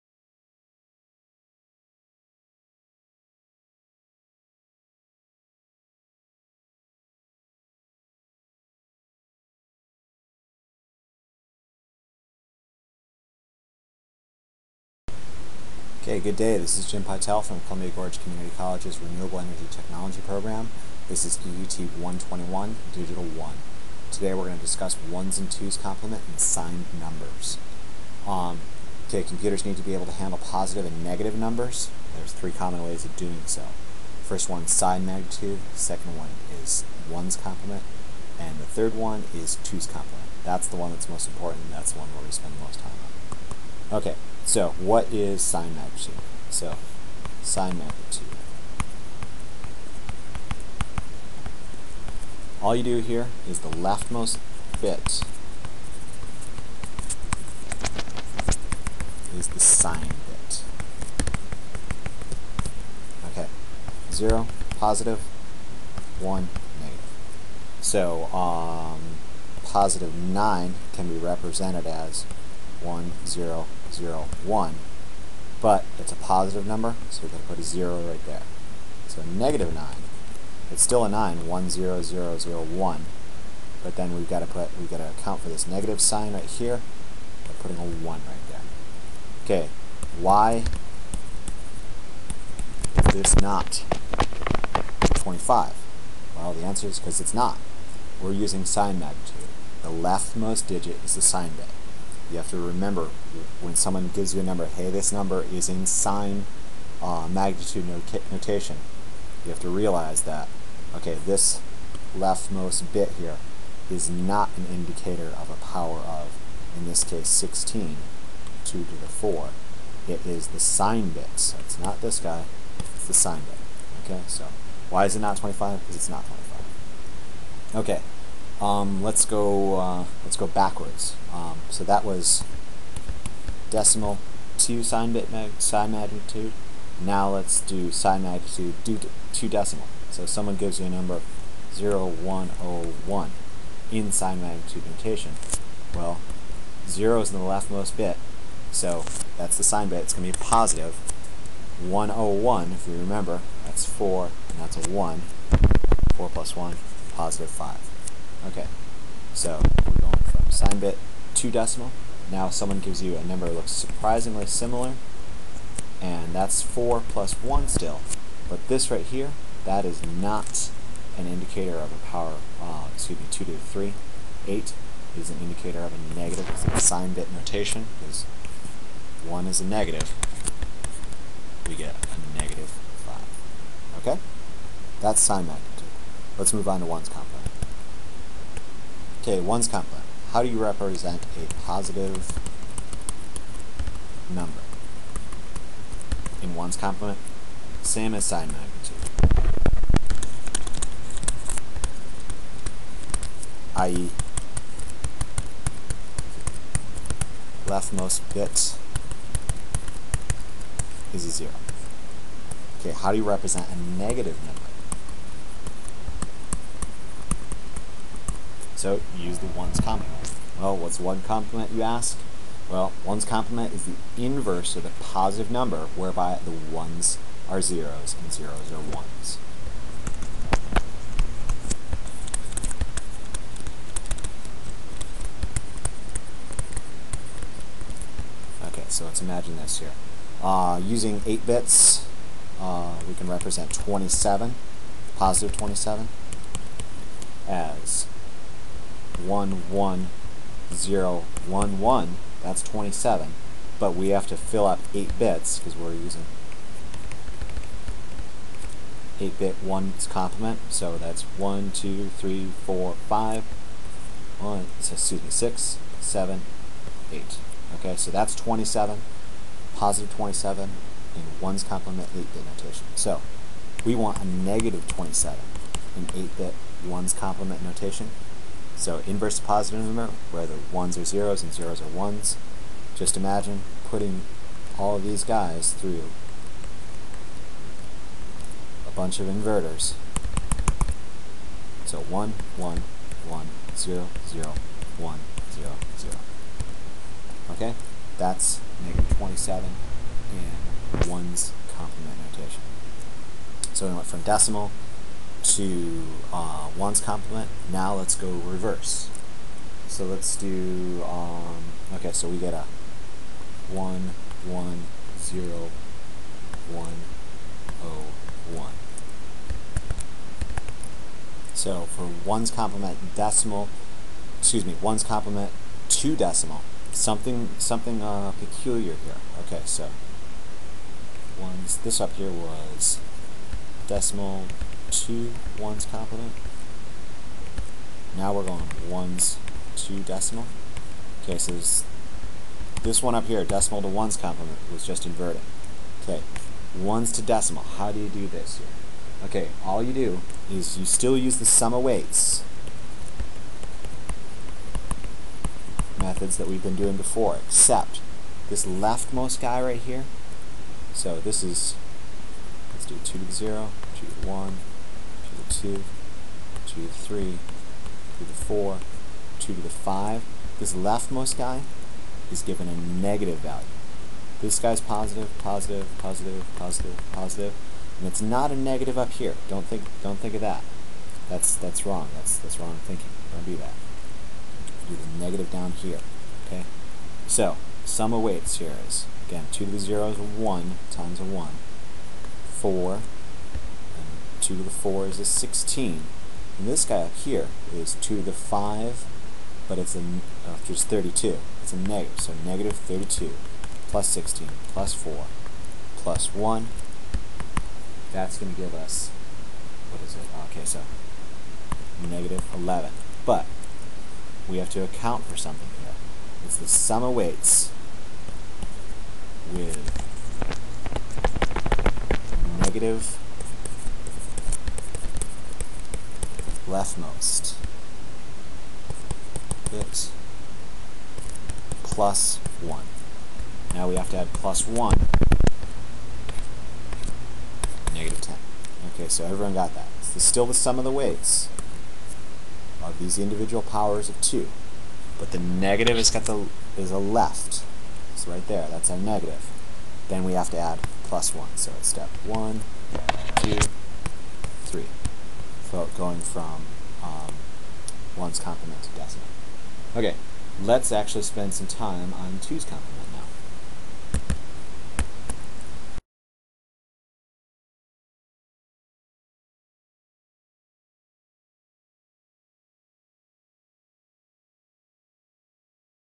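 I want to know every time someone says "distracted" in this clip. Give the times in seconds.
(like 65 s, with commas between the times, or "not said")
not said.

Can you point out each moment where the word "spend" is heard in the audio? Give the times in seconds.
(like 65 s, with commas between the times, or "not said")
42 s, 461 s.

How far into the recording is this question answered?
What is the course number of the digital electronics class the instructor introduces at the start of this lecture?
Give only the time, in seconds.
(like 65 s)
21 s.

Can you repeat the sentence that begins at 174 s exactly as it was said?
8 is an indicator of a negative.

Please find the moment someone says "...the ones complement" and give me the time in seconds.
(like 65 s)
219 s.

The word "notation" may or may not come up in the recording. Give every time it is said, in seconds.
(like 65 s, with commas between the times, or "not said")
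108 s, 144 s, 177 s, 272 s, 277 s, 302 s.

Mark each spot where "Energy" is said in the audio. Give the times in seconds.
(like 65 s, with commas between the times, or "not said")
19 s.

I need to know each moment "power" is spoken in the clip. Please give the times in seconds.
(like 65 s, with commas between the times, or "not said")
115 s, 172 s, 443 s.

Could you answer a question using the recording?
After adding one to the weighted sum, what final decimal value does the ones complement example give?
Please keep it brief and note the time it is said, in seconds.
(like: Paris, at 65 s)
negative 10, at 437 s.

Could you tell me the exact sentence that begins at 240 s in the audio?
Uh, using 8 bits, uh, we can represent 27, positive 27, as one one zero one one.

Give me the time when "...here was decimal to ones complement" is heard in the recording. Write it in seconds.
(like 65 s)
332 s.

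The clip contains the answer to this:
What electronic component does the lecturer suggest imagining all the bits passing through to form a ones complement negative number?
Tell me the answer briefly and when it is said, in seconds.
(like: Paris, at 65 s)
inverters, at 289 s.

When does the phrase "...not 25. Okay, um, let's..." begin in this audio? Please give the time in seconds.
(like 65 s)
126 s.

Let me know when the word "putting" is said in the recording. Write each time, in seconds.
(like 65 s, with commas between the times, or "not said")
87 s, 283 s.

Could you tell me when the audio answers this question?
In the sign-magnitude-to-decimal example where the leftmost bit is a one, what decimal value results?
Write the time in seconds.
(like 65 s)
182 s.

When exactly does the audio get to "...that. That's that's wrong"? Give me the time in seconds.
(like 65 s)
380 s.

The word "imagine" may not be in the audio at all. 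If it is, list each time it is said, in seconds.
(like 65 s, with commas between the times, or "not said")
239 s, 283 s.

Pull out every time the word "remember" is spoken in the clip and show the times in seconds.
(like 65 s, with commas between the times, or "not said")
102 s, 152 s.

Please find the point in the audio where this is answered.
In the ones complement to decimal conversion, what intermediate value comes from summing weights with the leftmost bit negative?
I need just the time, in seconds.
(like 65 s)
412 s.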